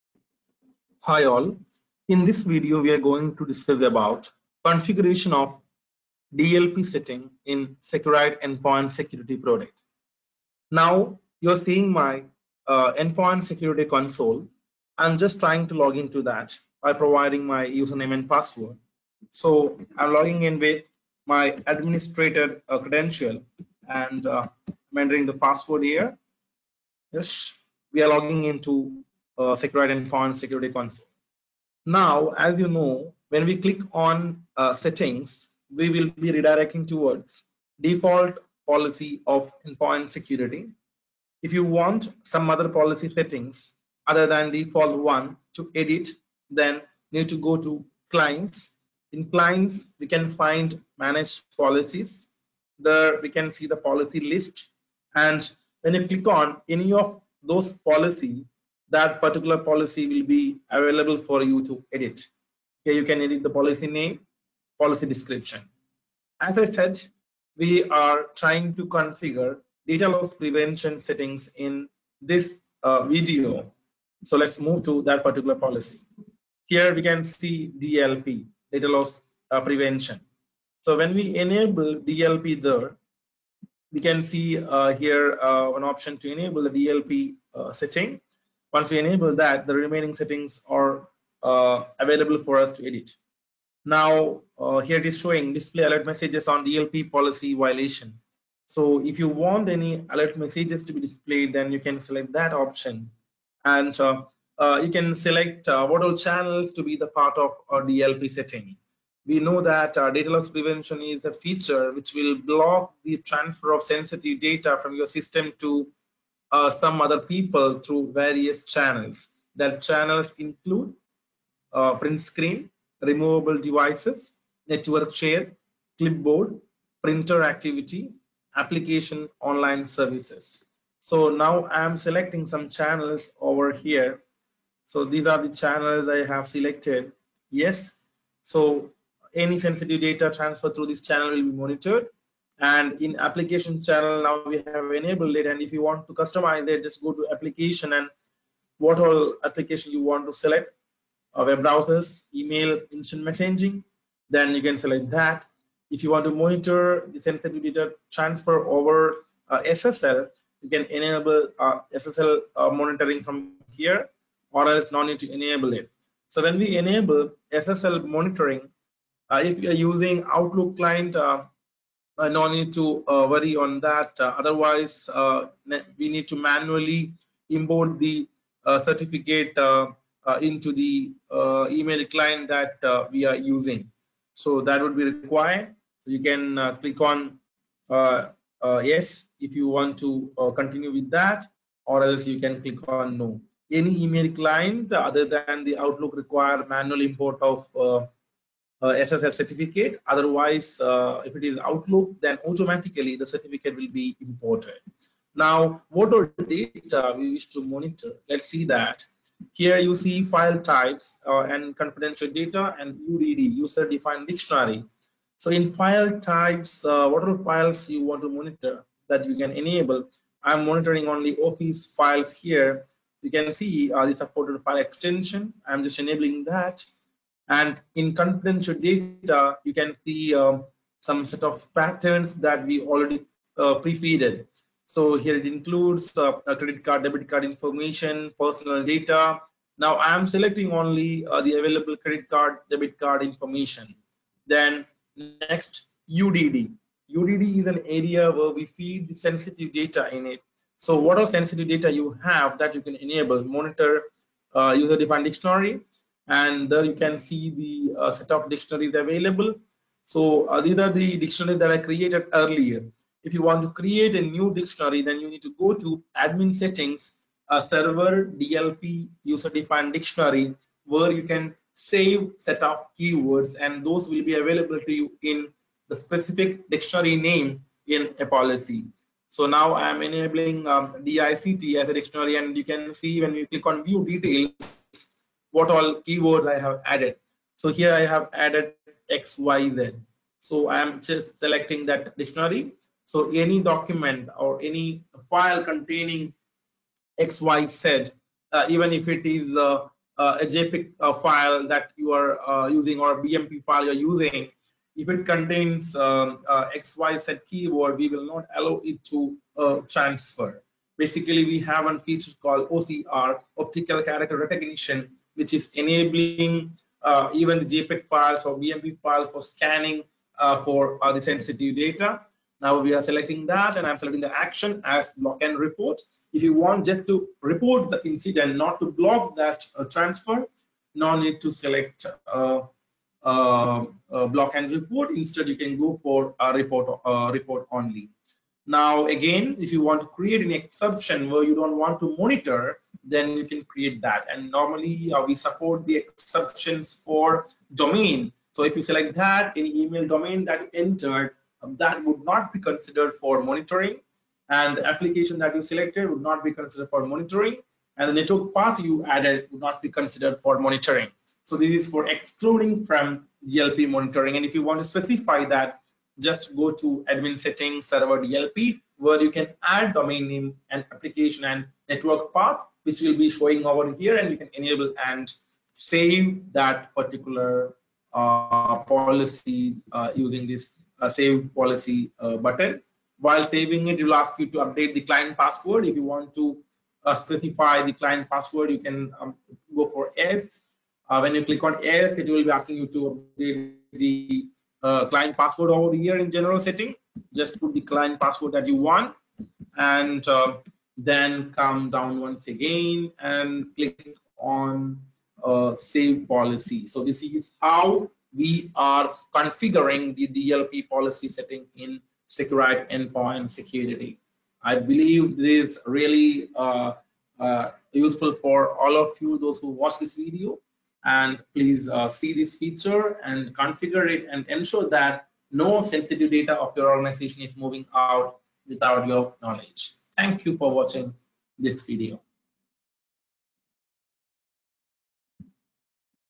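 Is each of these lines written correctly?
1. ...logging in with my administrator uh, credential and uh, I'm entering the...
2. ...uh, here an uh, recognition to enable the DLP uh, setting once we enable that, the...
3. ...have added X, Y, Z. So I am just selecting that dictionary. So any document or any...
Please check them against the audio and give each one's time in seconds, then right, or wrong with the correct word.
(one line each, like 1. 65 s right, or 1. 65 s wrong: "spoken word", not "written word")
1. 20 s right
2. 84 s wrong: "option", not "recognition"
3. 288 s right.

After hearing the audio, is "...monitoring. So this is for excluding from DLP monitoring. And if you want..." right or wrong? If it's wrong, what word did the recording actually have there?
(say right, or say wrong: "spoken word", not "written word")
right.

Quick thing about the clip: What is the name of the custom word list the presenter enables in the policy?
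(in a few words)
DICT.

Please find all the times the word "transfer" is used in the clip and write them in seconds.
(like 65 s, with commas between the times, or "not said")
113 s, 140 s, 158 s, 309 s, 329 s.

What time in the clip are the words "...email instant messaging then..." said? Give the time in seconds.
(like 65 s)
152 s.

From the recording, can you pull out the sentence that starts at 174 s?
Uh, otherwise, uh, we need to manually import the uh, certificate uh, into the email client that we are using.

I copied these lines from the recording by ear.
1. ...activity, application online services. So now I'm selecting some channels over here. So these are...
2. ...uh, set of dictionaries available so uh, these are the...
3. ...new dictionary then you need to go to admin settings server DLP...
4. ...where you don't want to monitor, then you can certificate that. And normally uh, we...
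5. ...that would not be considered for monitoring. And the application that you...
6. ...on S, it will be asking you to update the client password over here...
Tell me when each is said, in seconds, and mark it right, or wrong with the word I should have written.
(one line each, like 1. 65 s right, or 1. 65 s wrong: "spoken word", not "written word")
1. 127 s right
2. 258 s right
3. 264 s right
4. 341 s wrong: "create", not "certificate"
5. 351 s right
6. 391 s right.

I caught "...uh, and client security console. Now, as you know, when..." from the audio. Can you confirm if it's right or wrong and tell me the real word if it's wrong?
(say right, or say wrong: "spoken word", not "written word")
wrong: "endpoint", not "client".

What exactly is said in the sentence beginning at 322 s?
Now we are selecting that and I'm selecting the action as block and report.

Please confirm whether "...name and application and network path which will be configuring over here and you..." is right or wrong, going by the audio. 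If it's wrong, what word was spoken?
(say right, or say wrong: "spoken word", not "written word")
wrong: "showing", not "configuring".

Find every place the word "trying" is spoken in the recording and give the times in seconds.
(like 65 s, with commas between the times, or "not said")
15 s, 68 s.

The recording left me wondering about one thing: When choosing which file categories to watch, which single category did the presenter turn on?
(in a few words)
Office files.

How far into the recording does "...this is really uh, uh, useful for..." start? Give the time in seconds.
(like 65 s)
415 s.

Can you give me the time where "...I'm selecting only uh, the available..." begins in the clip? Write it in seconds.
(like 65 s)
239 s.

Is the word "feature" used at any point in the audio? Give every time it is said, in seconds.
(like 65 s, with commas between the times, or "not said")
111 s, 311 s, 422 s.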